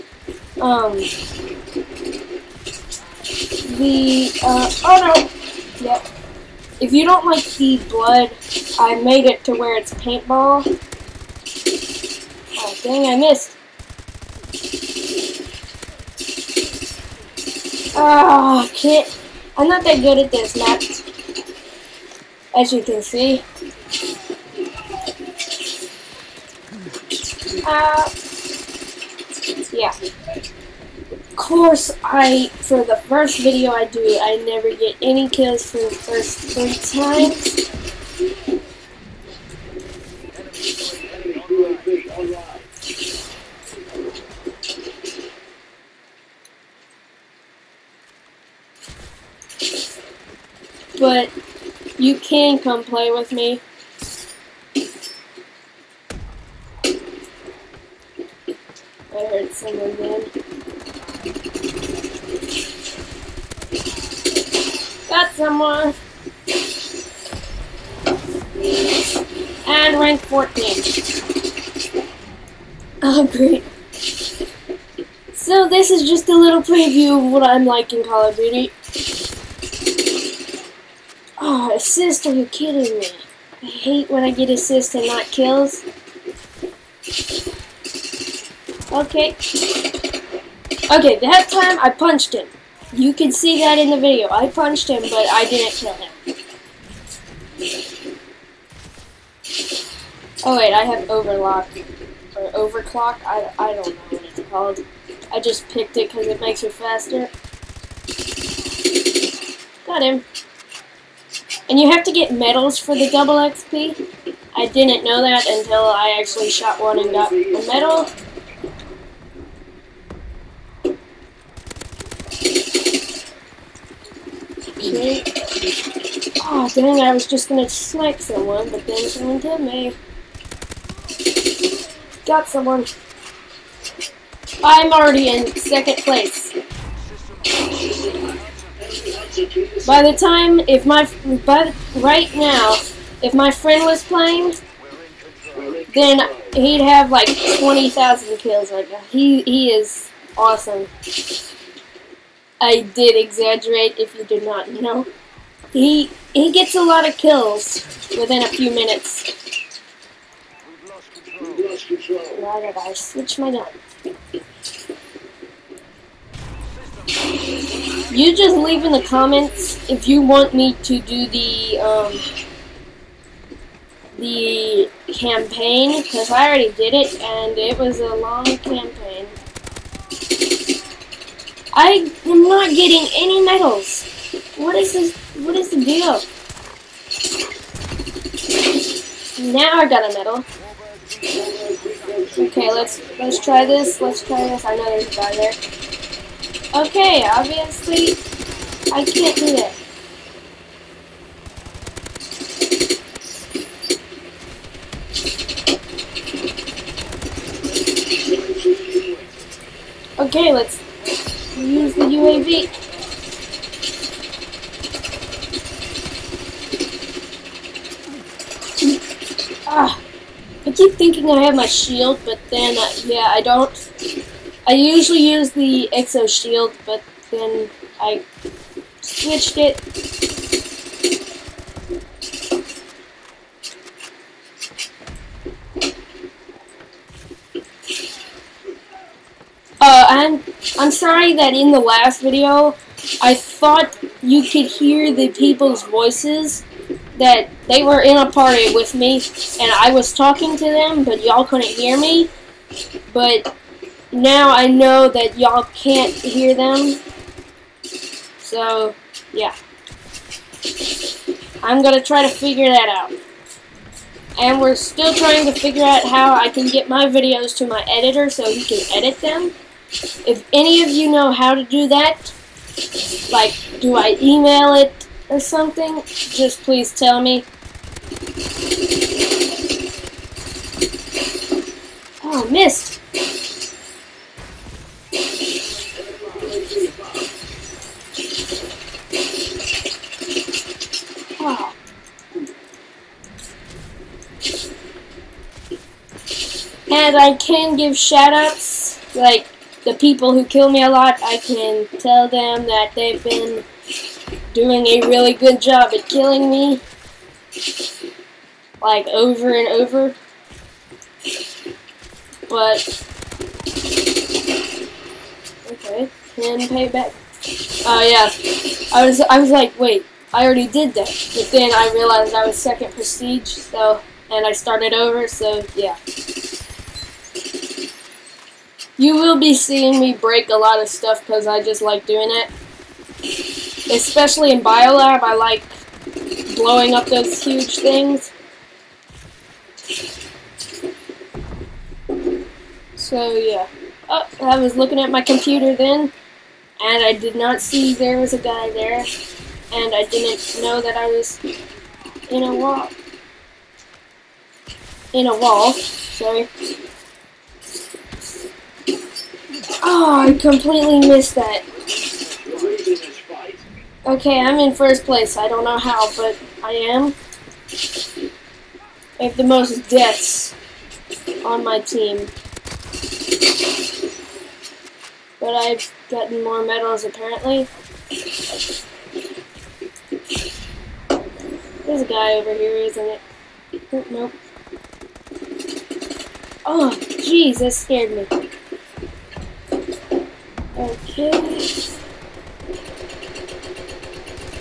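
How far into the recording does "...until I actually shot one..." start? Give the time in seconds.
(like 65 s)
115 s.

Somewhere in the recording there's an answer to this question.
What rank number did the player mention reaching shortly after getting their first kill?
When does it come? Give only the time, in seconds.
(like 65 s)
69 s.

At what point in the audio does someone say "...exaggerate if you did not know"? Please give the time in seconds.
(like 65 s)
153 s.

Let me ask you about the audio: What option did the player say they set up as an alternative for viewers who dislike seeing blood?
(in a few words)
Paintball.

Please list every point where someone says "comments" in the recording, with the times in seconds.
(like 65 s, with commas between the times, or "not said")
169 s.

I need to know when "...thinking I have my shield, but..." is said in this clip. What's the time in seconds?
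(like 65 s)
220 s.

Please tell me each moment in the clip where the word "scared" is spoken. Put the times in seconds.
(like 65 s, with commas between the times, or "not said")
387 s.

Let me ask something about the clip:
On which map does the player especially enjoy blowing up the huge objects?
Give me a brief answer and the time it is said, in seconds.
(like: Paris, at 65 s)
Biolab, at 334 s.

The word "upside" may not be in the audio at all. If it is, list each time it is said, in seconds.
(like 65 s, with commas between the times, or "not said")
not said.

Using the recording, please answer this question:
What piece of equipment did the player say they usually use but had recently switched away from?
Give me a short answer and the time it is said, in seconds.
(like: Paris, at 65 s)
Exo Shield, at 225 s.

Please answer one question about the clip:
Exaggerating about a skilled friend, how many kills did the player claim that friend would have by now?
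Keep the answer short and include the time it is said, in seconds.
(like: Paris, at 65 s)
20,000, at 147 s.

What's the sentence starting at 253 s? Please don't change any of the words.
But now I know that y'all can't hear them.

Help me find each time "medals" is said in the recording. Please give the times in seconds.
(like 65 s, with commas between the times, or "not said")
112 s, 117 s, 183 s, 190 s, 376 s.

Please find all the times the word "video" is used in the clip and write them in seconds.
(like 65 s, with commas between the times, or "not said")
33 s, 93 s, 242 s, 267 s.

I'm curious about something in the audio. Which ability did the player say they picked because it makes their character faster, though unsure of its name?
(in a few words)
Overclock.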